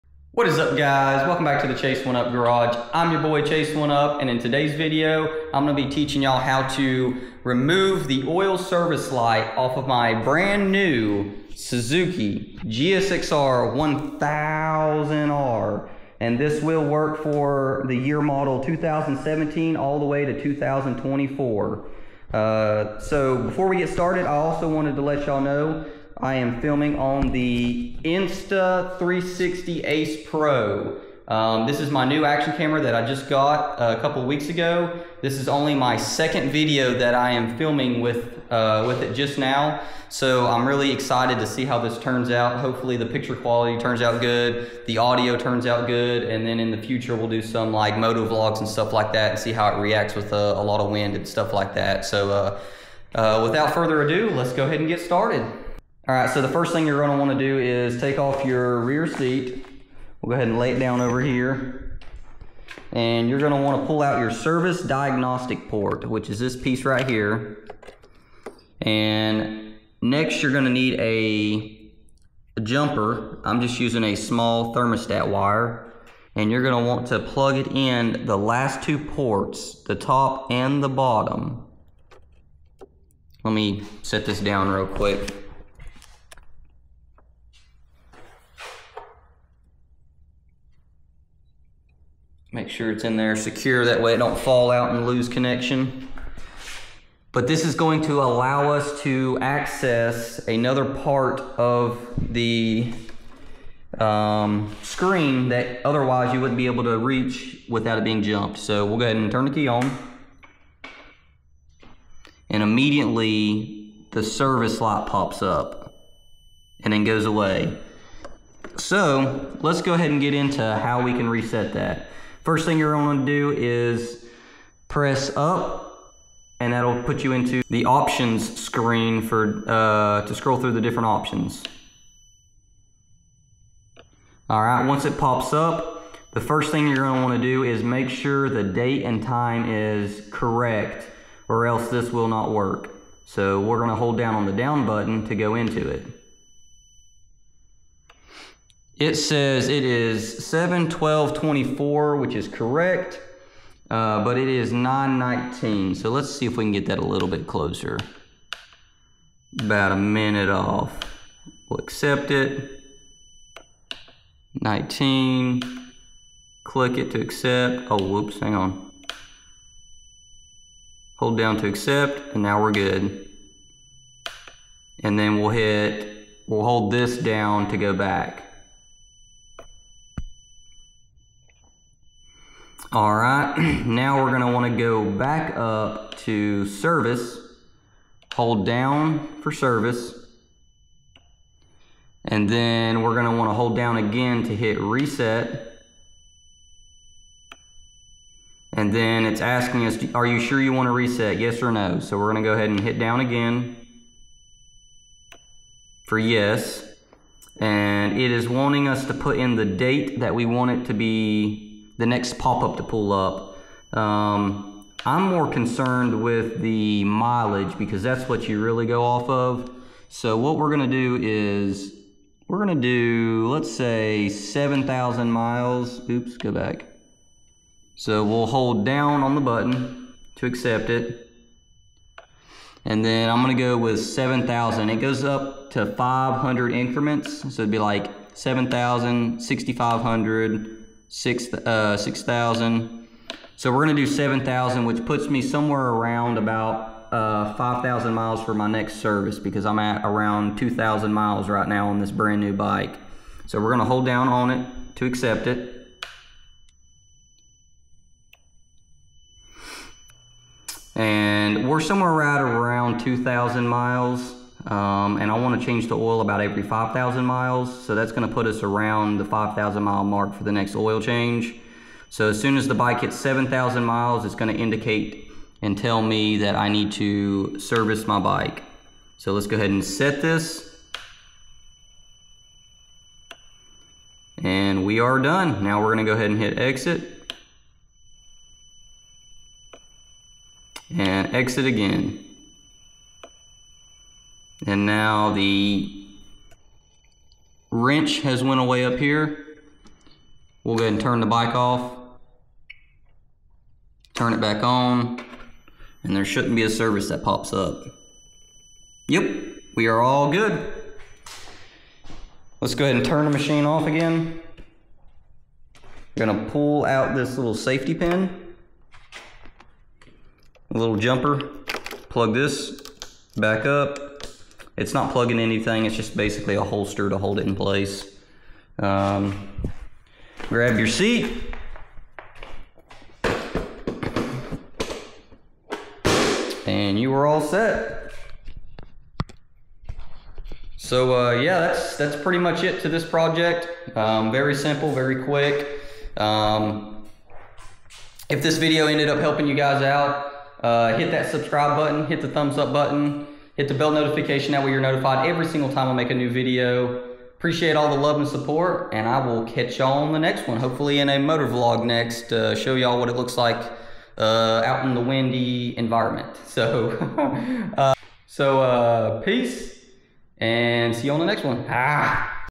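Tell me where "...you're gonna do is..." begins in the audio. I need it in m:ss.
2:02.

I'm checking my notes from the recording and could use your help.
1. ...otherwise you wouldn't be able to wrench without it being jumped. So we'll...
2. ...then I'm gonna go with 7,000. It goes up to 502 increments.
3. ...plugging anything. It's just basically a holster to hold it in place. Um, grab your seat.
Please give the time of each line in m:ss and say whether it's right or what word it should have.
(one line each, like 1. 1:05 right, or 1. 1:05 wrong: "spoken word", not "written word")
1. 1:45 wrong: "reach", not "wrench"
2. 3:53 wrong: "500", not "502"
3. 5:25 right.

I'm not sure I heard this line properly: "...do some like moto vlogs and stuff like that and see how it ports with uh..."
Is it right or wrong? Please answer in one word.
wrong.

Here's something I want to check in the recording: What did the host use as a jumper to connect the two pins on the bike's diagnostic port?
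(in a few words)
Thermostat wire.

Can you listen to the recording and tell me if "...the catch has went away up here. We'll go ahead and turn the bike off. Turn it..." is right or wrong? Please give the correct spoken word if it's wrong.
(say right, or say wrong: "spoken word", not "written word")
wrong: "wrench", not "catch".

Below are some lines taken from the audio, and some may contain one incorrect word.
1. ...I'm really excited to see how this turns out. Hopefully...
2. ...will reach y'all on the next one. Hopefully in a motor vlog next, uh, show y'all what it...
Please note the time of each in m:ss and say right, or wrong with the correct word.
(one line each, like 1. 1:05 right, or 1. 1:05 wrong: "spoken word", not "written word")
1. 0:40 right
2. 5:59 wrong: "catch", not "reach".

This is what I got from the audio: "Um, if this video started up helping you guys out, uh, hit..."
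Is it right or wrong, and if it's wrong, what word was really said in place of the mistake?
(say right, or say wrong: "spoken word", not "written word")
wrong: "ended", not "started".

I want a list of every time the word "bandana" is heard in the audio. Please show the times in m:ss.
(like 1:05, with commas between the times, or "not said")
not said.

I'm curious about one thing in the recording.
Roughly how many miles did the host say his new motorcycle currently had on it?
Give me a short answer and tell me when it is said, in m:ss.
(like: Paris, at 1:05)
2,000 miles, at 4:10.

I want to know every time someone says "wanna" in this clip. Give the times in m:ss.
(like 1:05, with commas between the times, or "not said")
0:57, 1:03, 2:17, 3:04, 3:13, 3:20.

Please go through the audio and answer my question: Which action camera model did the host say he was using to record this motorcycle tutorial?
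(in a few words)
Insta360 Ace Pro.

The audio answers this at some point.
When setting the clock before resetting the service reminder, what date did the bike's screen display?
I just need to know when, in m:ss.
2:30.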